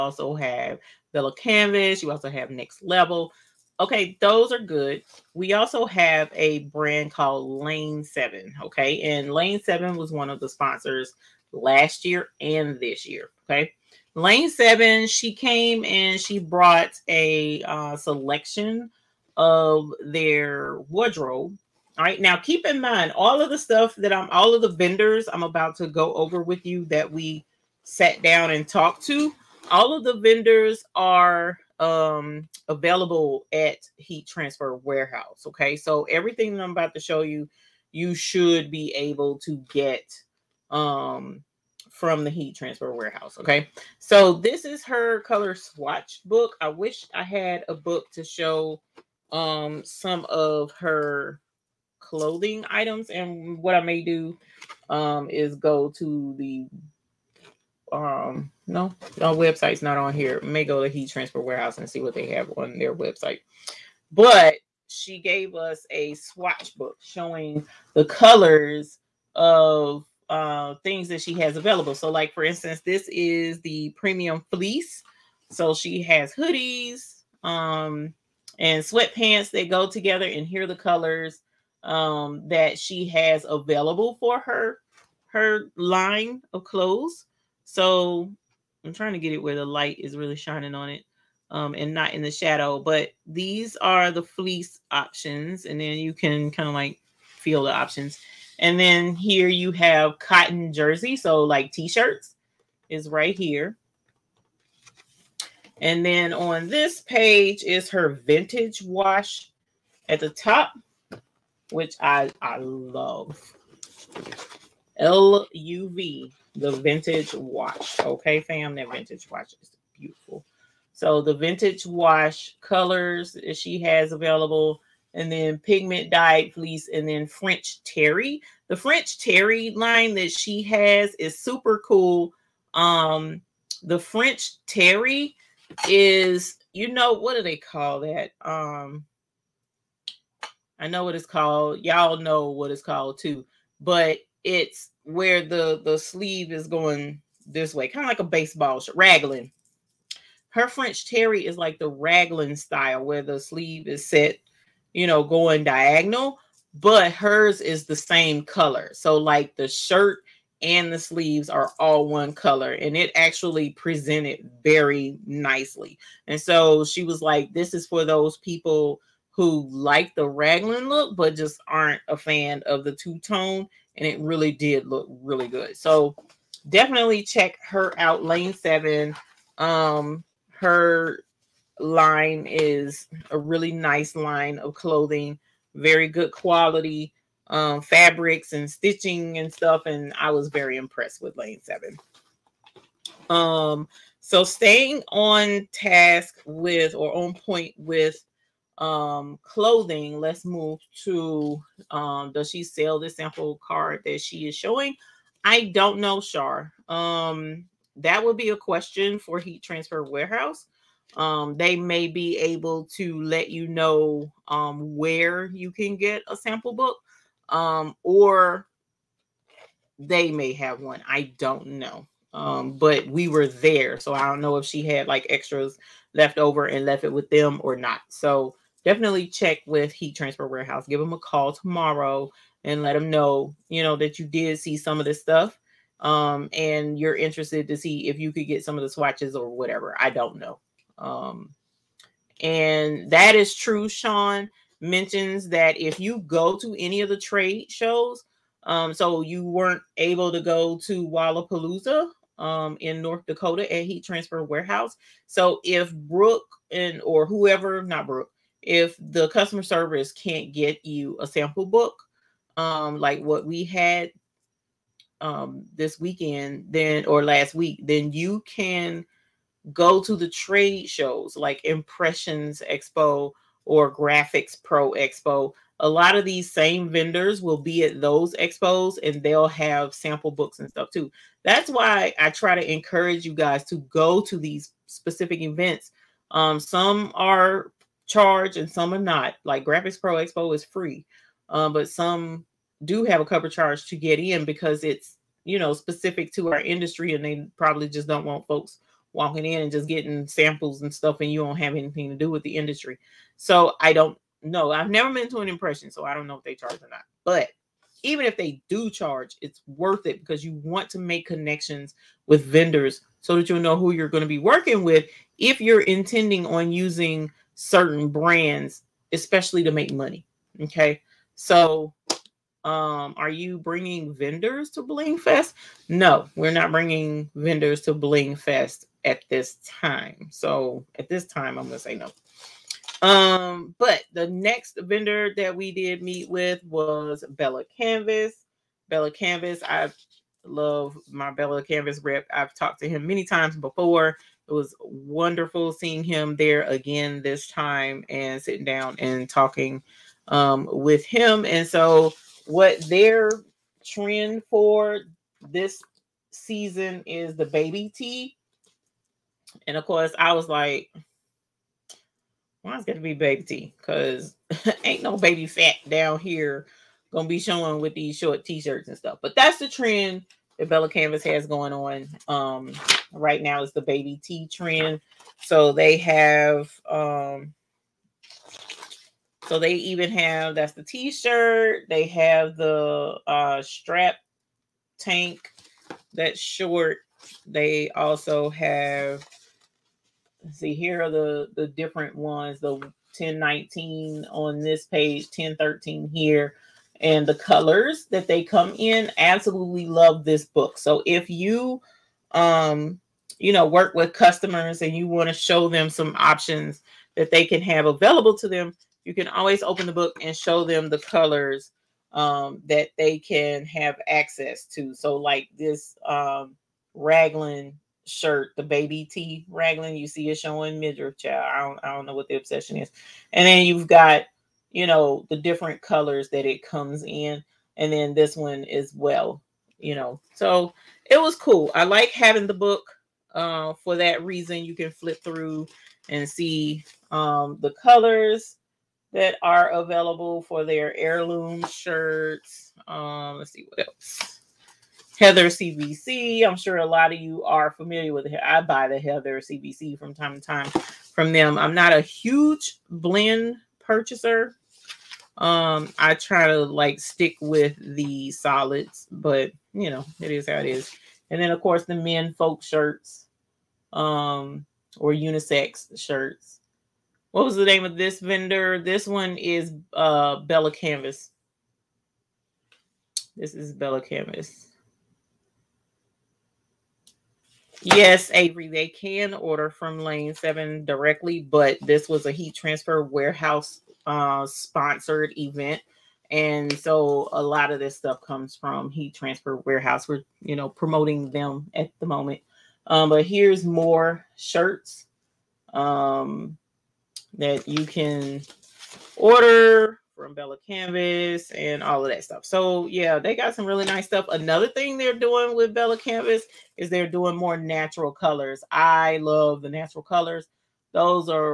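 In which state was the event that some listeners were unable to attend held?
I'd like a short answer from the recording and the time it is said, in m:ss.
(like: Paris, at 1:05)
North Dakota, at 4:13.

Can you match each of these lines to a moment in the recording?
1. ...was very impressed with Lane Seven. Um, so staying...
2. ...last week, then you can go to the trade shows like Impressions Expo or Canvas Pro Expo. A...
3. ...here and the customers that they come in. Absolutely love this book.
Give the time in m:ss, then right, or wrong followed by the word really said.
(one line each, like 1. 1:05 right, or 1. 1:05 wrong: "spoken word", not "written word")
1. 3:10 right
2. 4:27 wrong: "Graphics", not "Canvas"
3. 6:36 wrong: "colors", not "customers".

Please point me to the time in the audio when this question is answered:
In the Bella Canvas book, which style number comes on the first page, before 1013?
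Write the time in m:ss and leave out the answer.
6:32.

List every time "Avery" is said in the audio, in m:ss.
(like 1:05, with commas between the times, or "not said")
7:58.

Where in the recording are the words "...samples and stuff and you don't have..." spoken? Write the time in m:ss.
5:00.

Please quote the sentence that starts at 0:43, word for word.
Okay, so this is her color swatch book.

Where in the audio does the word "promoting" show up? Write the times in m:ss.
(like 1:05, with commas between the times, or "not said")
8:10.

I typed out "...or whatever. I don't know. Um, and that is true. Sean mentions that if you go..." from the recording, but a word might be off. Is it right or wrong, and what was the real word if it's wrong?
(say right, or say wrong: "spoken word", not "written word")
right.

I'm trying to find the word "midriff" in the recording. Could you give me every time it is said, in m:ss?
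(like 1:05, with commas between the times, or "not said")
7:00.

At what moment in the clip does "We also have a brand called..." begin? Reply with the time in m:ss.
0:05.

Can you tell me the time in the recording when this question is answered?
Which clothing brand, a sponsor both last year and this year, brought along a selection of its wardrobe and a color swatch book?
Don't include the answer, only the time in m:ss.
0:14.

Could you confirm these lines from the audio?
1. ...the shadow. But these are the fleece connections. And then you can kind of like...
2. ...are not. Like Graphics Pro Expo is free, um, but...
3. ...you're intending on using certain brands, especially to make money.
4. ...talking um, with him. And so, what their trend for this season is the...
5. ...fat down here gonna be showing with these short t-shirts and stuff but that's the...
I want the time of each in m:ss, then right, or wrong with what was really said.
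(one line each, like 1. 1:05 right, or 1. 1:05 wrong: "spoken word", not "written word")
1. 1:32 wrong: "options", not "connections"
2. 4:48 right
3. 5:15 right
4. 5:49 right
5. 6:05 right.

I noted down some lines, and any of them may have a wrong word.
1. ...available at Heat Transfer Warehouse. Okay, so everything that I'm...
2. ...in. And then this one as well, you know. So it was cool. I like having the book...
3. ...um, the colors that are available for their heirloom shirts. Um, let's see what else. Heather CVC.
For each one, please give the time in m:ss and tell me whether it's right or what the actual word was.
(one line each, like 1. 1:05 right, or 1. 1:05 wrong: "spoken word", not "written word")
1. 0:32 right
2. 7:07 right
3. 7:17 right.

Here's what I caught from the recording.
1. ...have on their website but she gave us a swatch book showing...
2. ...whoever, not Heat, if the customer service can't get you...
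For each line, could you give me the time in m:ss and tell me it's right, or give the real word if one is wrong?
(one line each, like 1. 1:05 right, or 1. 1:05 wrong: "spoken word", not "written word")
1. 1:02 right
2. 4:17 wrong: "Brooke", not "Heat".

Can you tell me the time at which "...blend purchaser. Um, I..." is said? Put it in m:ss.
7:32.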